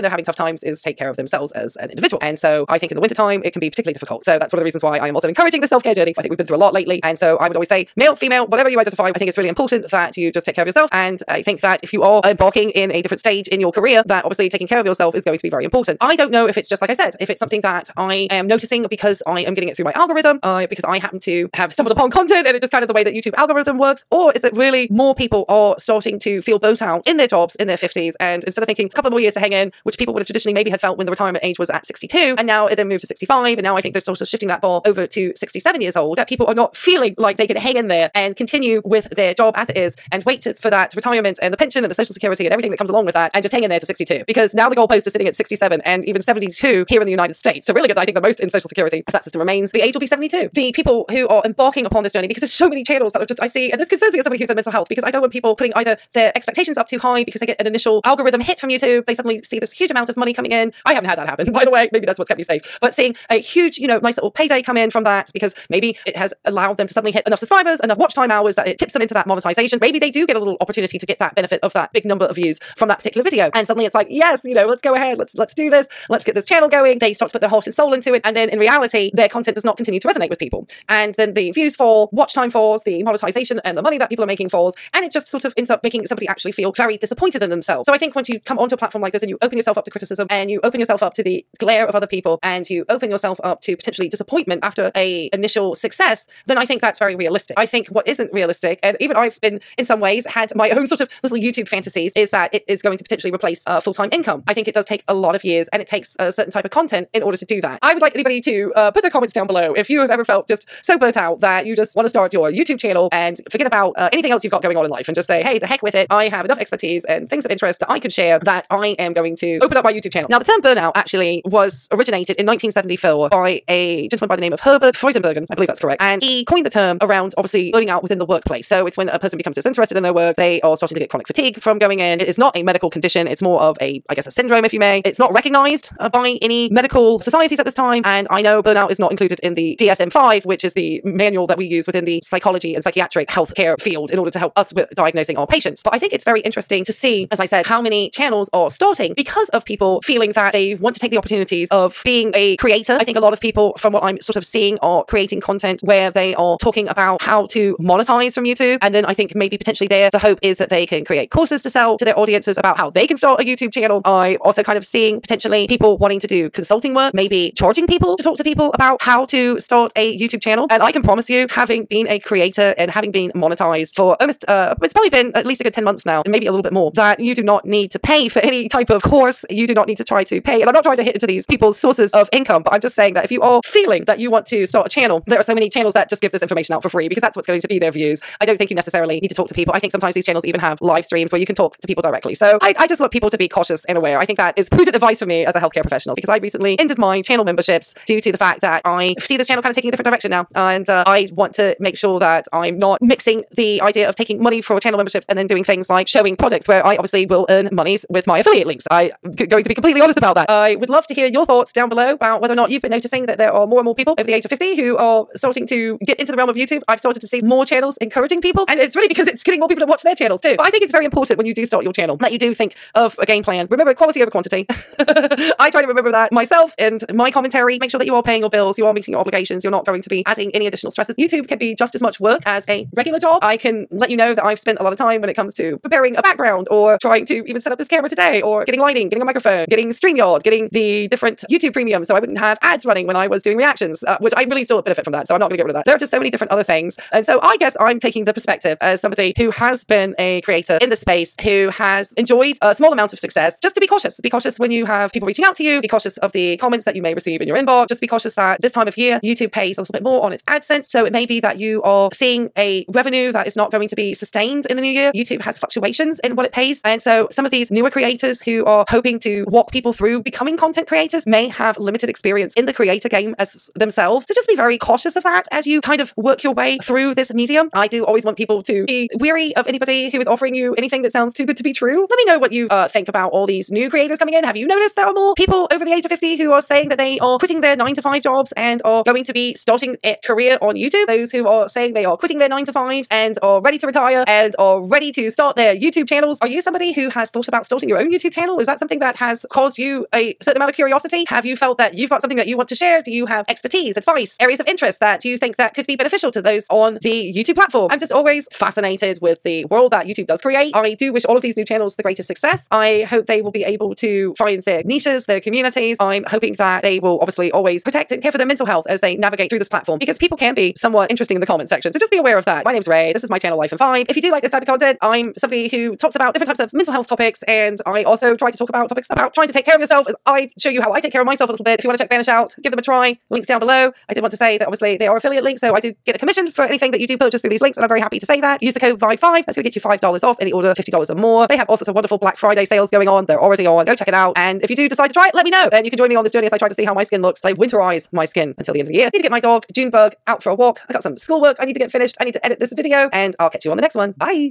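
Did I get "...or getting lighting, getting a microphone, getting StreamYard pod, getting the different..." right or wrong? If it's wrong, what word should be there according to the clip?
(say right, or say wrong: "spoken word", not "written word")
right.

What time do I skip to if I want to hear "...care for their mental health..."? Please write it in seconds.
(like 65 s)
318 s.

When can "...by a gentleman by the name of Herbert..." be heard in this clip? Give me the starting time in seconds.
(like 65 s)
123 s.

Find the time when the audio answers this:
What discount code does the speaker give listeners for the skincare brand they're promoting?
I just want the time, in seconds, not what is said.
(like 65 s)
338 s.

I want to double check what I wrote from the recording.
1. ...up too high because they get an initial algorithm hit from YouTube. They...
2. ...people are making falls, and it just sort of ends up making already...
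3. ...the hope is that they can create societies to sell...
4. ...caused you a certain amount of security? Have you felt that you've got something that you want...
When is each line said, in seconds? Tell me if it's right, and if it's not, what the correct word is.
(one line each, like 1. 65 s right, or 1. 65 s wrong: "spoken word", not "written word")
1. 56 s right
2. 84 s wrong: "somebody", not "already"
3. 160 s wrong: "courses", not "societies"
4. 299 s wrong: "curiosity", not "security".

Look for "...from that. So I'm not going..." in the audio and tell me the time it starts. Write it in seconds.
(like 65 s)
245 s.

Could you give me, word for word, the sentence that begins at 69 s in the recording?
Maybe they do get a little opportunity to get that benefit benefit of that big number of views from that particular video.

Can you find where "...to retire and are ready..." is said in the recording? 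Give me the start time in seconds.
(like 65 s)
293 s.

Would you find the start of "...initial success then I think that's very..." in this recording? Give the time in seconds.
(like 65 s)
95 s.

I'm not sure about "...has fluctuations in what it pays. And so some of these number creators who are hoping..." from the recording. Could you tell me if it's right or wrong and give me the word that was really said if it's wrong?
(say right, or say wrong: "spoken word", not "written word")
wrong: "newer", not "number".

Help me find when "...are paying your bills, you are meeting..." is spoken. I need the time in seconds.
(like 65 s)
228 s.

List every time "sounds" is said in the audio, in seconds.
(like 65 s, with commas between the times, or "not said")
281 s.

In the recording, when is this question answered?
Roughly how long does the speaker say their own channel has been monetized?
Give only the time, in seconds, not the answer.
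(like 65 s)
175 s.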